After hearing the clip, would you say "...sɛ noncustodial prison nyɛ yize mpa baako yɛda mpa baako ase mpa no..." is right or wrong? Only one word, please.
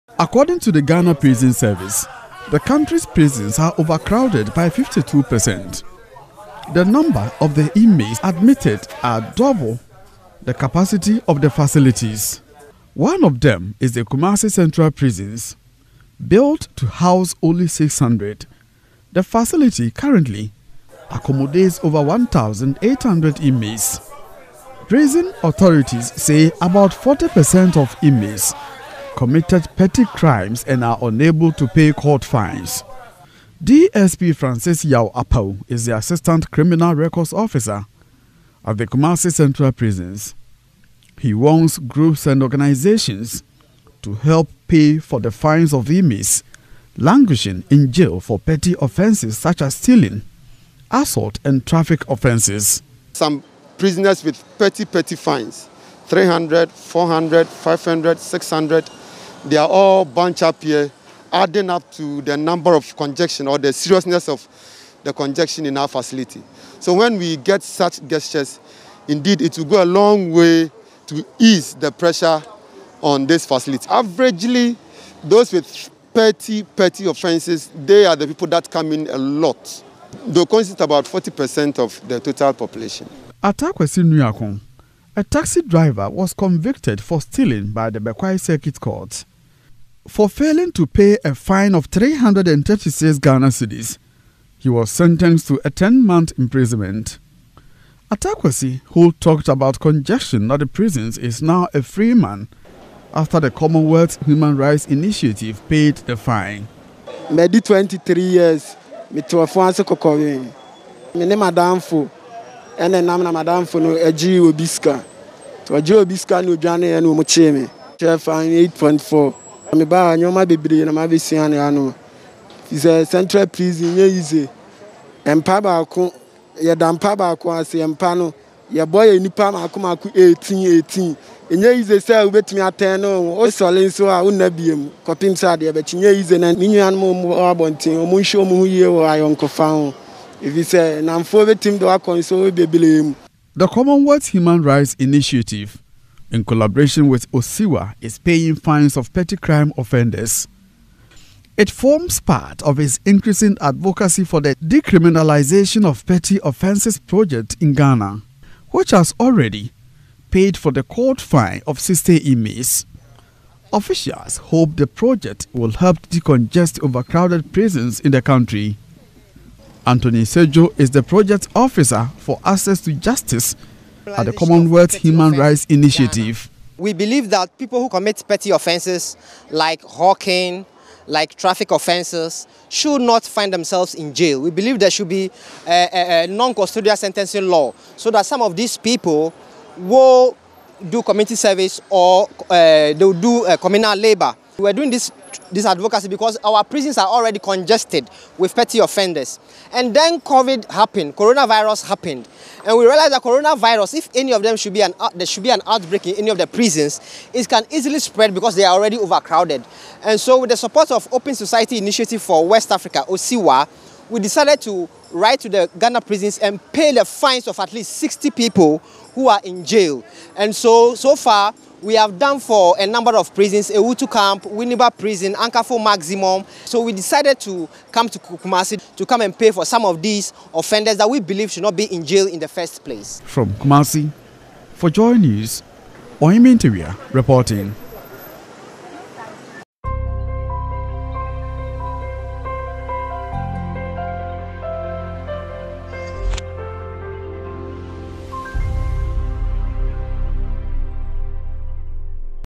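wrong.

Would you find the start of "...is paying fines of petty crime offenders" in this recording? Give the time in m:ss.
2:28.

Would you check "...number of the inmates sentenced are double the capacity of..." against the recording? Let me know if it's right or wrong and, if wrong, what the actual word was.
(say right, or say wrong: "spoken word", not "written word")
wrong: "admitted", not "sentenced".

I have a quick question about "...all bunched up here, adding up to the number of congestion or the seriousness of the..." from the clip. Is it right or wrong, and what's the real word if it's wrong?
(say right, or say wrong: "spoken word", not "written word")
right.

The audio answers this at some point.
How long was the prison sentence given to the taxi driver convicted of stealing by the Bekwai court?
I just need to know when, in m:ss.
1:35.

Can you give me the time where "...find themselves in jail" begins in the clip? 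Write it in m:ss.
3:03.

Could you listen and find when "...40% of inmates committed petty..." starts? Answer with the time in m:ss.
0:26.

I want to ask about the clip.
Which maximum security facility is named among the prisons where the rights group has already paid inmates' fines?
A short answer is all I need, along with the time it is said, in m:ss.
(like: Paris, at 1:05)
Ankaful, at 3:45.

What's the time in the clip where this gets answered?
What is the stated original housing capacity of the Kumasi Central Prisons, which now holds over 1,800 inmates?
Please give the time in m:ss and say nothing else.
0:16.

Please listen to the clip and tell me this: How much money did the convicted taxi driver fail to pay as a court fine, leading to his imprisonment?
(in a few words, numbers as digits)
336 Ghana cedis.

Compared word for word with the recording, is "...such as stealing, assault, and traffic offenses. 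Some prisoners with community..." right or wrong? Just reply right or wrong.
wrong.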